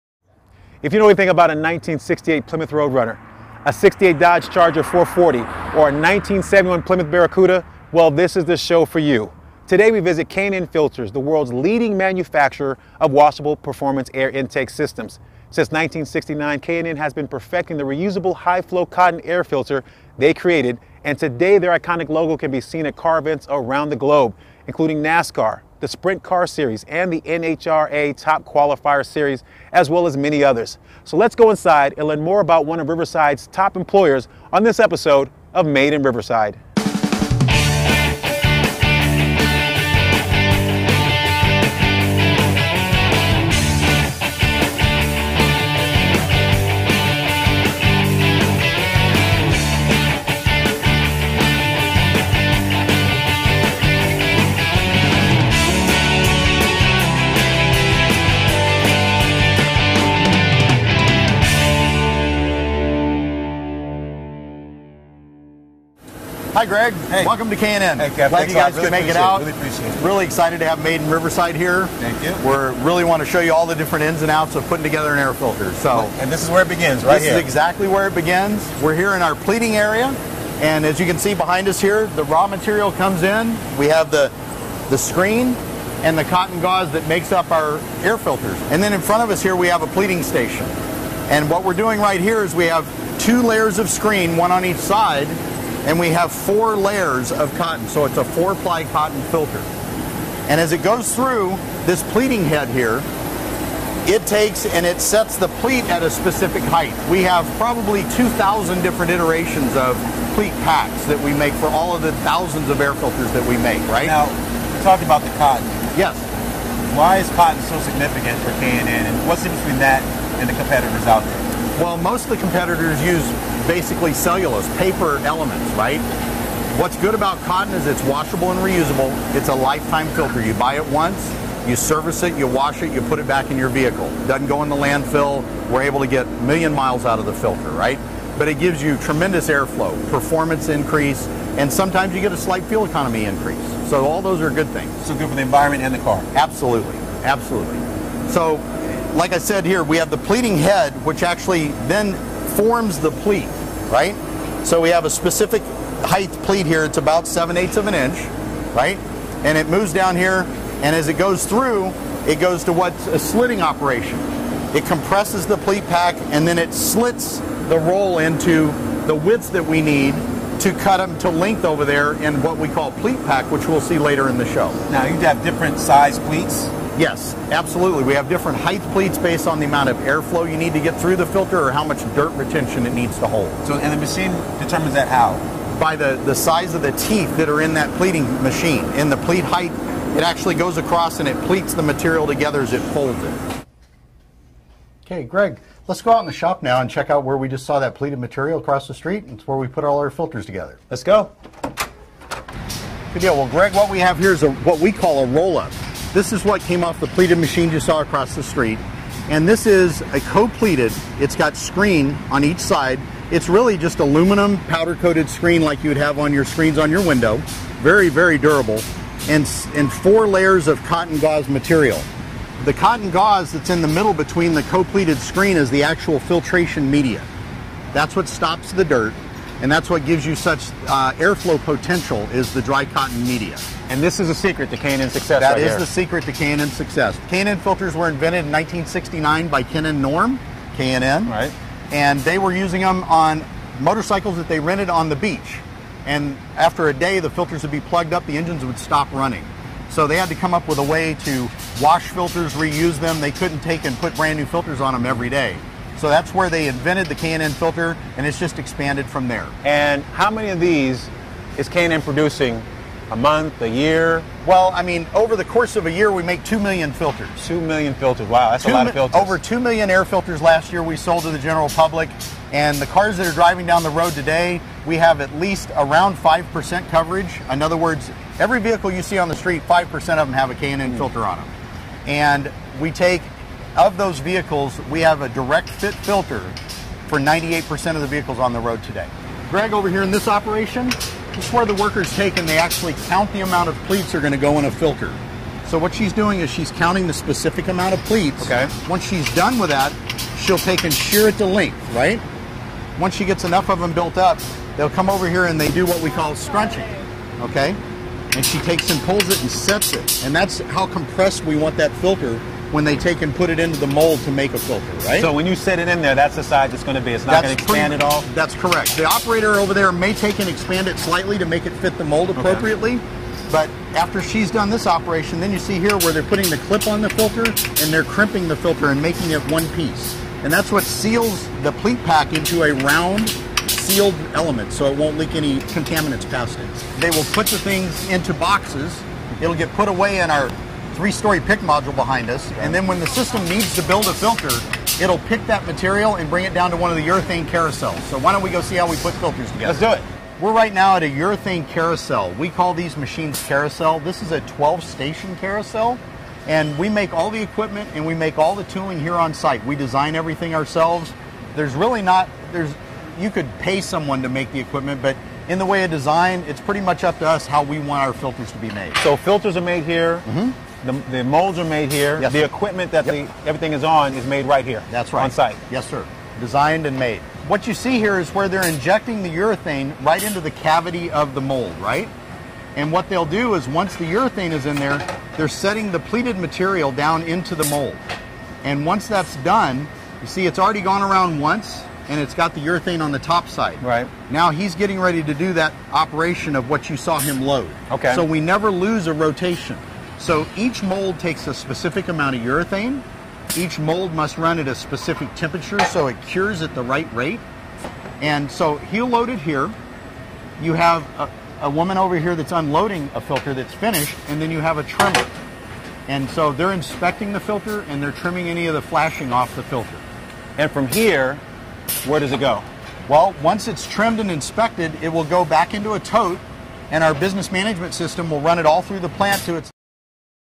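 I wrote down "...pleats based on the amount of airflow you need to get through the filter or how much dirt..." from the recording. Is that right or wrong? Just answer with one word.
right.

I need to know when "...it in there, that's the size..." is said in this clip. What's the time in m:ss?
5:15.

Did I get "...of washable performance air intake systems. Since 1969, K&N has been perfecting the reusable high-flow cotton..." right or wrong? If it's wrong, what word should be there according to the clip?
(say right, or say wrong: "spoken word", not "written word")
right.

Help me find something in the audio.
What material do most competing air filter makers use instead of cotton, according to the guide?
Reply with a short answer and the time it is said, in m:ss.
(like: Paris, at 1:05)
Cellulose, at 2:04.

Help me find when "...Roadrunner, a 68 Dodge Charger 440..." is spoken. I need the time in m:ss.
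0:02.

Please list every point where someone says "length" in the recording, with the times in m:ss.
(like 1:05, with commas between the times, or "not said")
2:51, 5:01.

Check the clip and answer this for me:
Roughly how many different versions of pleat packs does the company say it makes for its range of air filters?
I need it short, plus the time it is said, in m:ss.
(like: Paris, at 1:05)
2,000, at 1:48.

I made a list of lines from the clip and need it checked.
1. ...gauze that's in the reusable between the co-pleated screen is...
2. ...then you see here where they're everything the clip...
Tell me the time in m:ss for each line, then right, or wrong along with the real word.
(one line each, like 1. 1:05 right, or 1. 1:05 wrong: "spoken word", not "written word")
1. 3:43 wrong: "middle", not "reusable"
2. 5:25 wrong: "putting", not "everything".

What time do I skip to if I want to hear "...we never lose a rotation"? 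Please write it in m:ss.
6:38.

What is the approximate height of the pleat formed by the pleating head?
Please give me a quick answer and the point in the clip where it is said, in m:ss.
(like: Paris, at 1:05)
7/8 of an inch, at 2:37.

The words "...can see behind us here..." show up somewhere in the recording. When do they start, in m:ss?
1:21.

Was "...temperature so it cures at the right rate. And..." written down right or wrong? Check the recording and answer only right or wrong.
right.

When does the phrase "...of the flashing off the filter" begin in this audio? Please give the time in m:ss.
6:58.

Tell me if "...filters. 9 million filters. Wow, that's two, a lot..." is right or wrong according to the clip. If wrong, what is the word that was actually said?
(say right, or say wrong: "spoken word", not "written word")
wrong: "2", not "9".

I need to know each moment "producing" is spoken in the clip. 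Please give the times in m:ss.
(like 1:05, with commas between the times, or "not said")
4:22.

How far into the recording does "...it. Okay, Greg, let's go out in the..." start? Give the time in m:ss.
3:13.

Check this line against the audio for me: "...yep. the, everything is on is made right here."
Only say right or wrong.
right.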